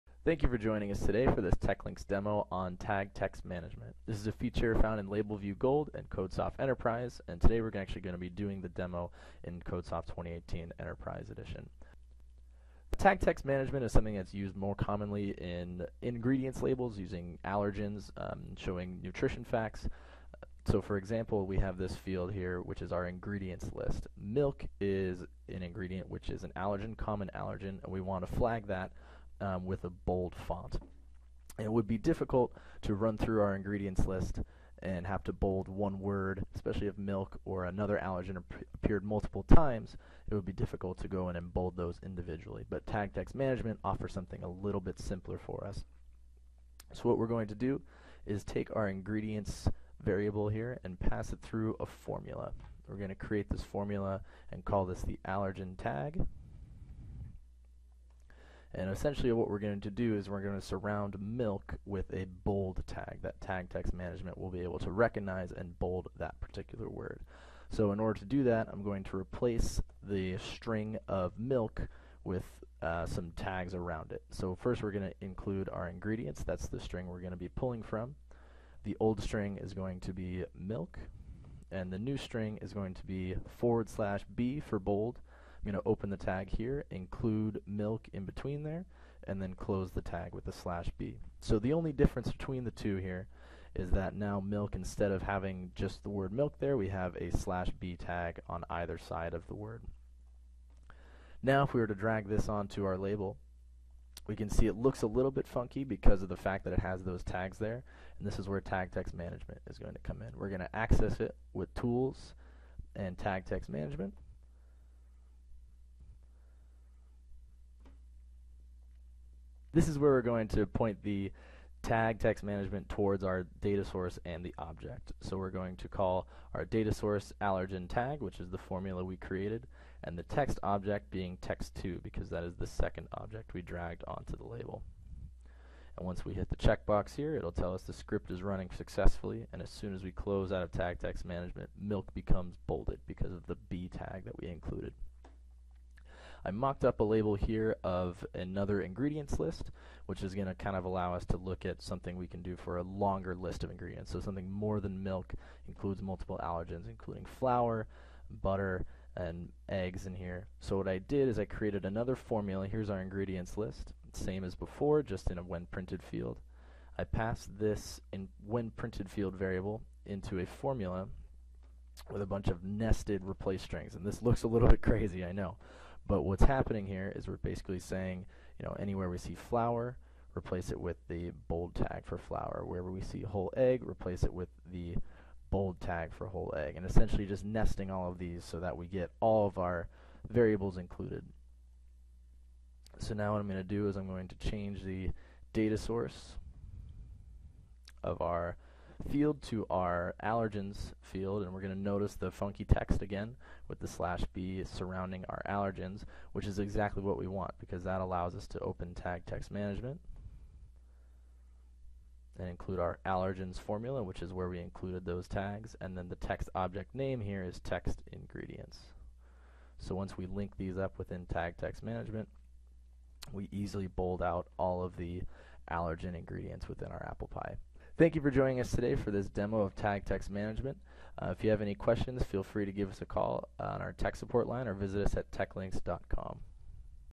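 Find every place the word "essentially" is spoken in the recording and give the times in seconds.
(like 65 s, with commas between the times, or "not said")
58 s, 186 s.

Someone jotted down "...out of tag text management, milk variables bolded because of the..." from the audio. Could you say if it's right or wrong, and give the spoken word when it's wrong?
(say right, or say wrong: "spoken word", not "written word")
wrong: "becomes", not "variables".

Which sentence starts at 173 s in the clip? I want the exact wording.
And this looks a little bit crazy, I know.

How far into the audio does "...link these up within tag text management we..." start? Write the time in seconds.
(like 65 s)
220 s.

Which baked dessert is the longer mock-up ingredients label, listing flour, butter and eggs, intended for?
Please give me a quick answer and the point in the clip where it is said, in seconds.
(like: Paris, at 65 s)
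apple pie, at 227 s.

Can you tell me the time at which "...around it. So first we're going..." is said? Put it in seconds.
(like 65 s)
73 s.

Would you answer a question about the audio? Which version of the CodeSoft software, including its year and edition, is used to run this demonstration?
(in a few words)
CodeSoft 2018 Enterprise.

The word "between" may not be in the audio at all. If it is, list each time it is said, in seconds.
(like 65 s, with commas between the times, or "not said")
88 s, 92 s.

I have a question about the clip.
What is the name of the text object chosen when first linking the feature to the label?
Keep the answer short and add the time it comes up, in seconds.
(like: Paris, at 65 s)
text2, at 131 s.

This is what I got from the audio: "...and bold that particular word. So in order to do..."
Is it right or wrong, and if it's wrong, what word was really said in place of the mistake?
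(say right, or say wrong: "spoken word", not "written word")
right.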